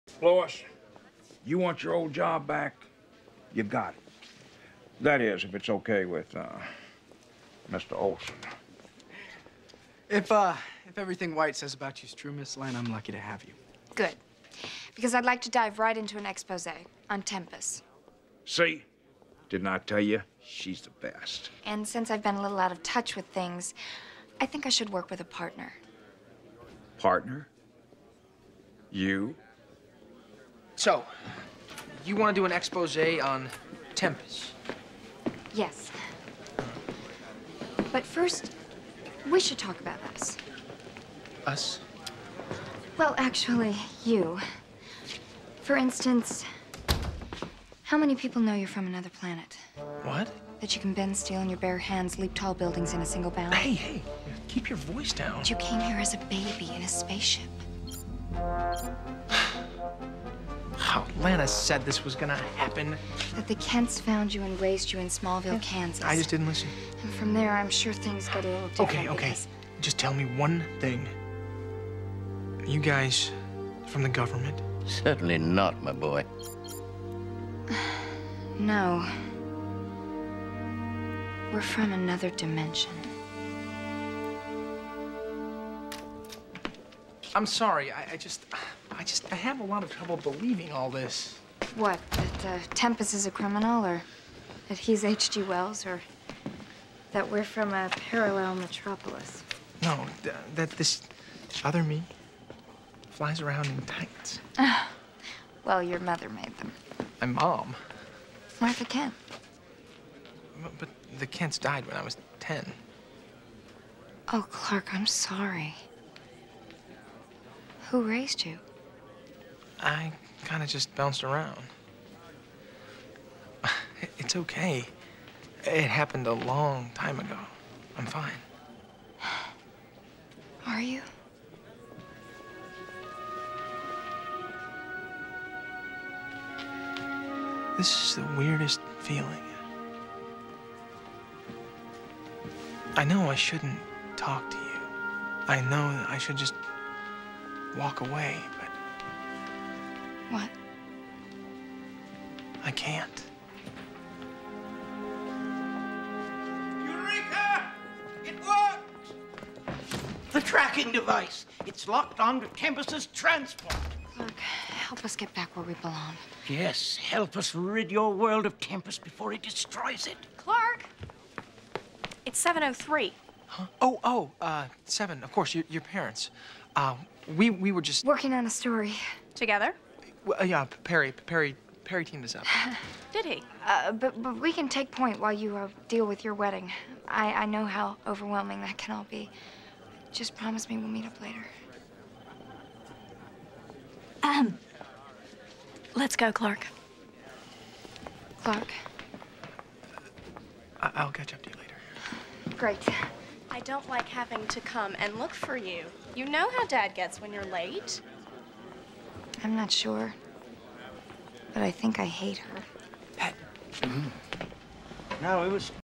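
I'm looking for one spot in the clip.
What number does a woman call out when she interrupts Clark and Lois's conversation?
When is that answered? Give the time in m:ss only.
2:52.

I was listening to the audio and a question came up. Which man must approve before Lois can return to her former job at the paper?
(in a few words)
Mr. Olsen.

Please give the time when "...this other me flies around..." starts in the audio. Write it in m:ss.
1:40.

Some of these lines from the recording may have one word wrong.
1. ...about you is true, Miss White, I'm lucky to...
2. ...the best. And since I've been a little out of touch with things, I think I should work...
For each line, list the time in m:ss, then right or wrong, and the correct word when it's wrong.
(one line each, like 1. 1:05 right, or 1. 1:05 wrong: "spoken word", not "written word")
1. 0:11 wrong: "Lane", not "White"
2. 0:20 right.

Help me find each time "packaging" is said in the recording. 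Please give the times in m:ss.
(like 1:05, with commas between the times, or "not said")
not said.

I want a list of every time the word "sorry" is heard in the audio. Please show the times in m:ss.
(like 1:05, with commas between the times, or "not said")
1:27, 1:55.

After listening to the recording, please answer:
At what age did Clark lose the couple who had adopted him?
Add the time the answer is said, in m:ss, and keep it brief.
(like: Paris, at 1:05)
10, at 1:52.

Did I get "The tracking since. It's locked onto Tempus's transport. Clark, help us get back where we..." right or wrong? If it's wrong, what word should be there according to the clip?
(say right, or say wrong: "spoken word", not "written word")
wrong: "device", not "since".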